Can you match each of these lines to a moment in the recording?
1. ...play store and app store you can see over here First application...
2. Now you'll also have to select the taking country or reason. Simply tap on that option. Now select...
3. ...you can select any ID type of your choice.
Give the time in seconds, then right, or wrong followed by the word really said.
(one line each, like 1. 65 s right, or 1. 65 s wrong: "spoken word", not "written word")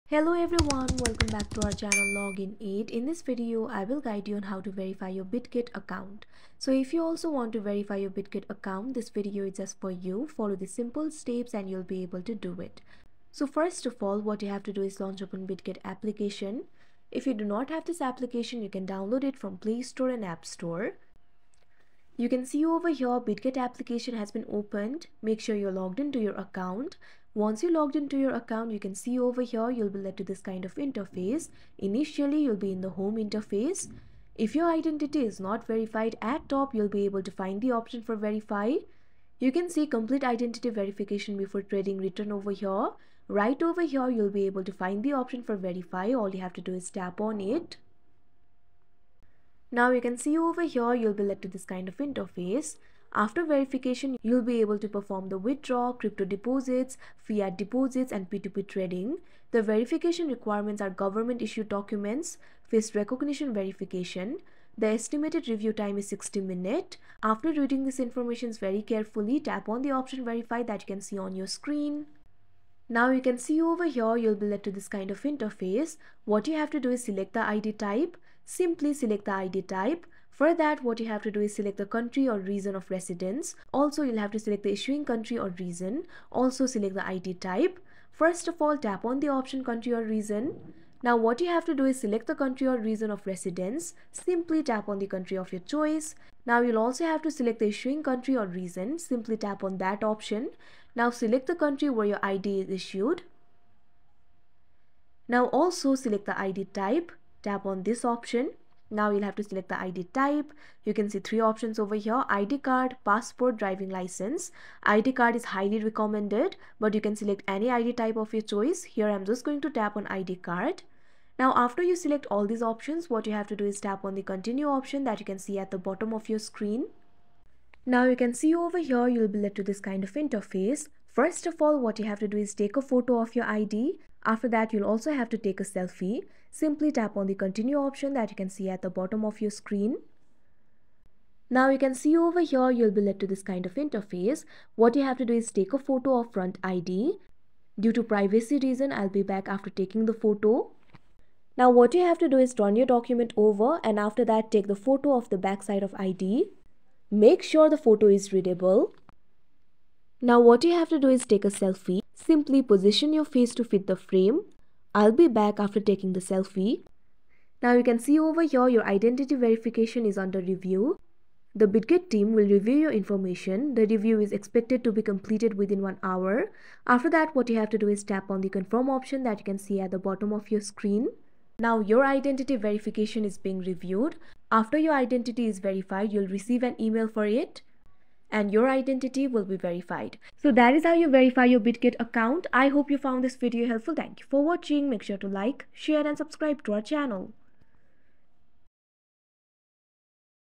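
1. 19 s wrong: "BitGet", not "First"
2. 96 s wrong: "issuing", not "taking"
3. 116 s right.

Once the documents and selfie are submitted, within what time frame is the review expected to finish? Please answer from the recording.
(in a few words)
one hour.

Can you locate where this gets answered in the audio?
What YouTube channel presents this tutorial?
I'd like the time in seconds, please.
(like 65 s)
2 s.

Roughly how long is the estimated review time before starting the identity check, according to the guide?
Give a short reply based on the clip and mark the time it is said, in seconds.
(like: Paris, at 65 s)
60 minutes, at 66 s.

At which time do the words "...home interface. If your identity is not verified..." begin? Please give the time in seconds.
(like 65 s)
32 s.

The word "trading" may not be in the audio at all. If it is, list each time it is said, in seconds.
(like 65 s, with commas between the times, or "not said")
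41 s, 58 s.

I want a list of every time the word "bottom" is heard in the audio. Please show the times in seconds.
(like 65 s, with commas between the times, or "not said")
125 s, 138 s, 179 s.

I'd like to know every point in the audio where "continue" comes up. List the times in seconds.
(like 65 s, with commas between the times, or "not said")
124 s, 137 s.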